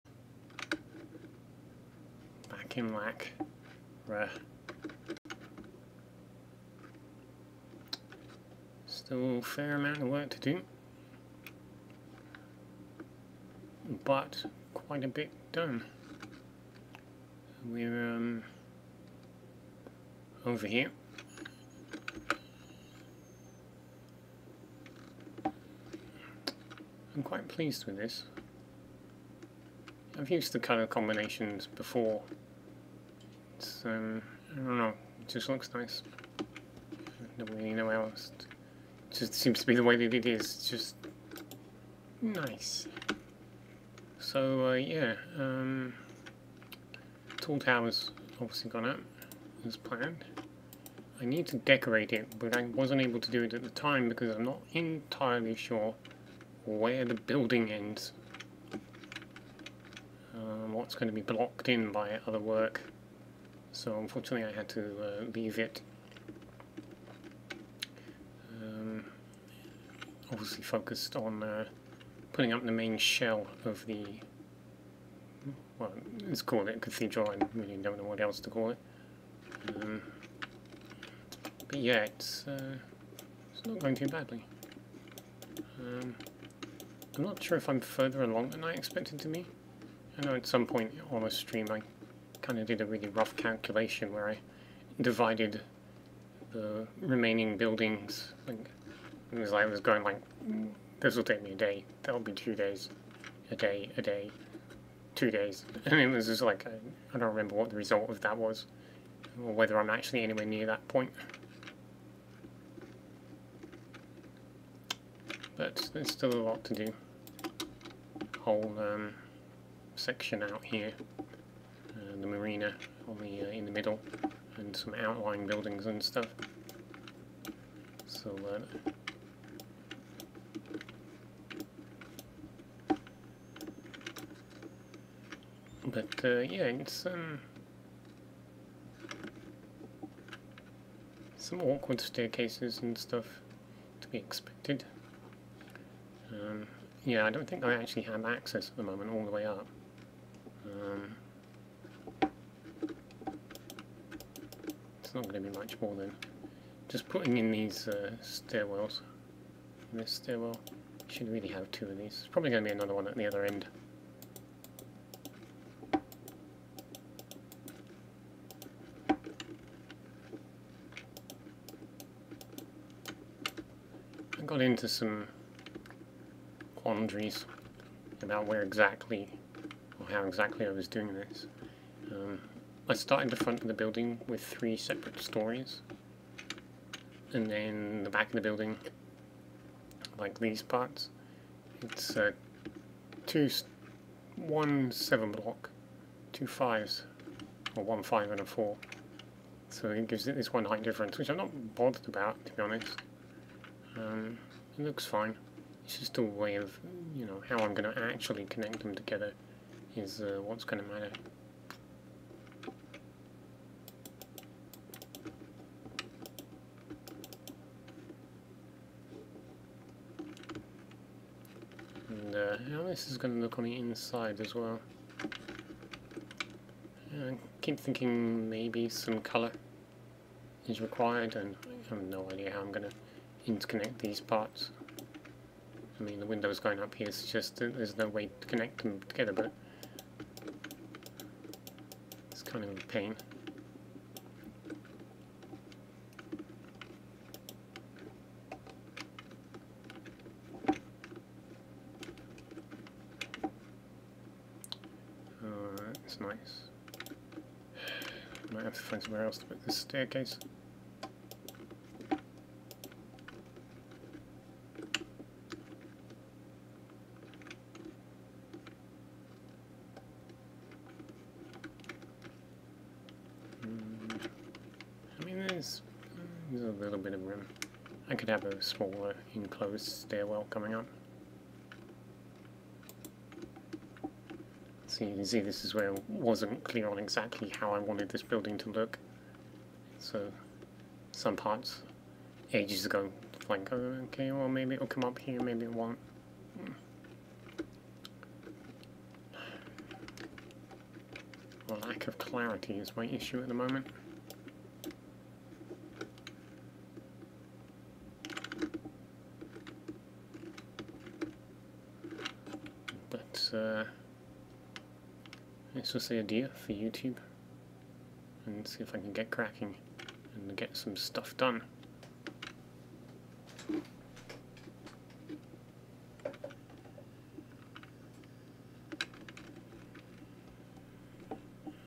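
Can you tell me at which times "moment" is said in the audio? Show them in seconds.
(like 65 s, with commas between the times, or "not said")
148 s, 303 s.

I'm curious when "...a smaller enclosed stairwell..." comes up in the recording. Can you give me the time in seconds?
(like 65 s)
278 s.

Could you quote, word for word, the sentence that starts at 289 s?
So some parts ages ago, like, okay, well maybe it'll come up here, maybe it won't.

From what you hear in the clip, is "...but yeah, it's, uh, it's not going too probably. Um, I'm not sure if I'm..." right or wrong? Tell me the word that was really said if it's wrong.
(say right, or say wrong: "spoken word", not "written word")
wrong: "badly", not "probably".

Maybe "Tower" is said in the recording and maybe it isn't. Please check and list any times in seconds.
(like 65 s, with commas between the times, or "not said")
47 s.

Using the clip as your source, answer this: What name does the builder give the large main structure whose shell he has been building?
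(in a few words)
cathedral.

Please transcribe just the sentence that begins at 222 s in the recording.
And How uh, this is going to look on the inside as well.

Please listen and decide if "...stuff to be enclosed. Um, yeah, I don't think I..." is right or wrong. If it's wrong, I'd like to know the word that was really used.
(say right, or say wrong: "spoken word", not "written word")
wrong: "expected", not "enclosed".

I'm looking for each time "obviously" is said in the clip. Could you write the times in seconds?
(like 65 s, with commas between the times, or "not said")
48 s, 70 s.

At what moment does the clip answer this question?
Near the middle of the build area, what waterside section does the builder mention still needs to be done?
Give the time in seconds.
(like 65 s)
122 s.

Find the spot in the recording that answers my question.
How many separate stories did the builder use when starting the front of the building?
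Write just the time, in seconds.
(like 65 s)
184 s.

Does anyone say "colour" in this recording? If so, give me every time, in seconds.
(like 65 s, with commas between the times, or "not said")
30 s, 229 s.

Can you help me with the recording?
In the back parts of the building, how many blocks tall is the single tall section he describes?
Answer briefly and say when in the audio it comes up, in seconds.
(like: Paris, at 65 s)
7, at 194 s.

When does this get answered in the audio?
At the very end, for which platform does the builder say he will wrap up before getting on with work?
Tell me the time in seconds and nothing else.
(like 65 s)
316 s.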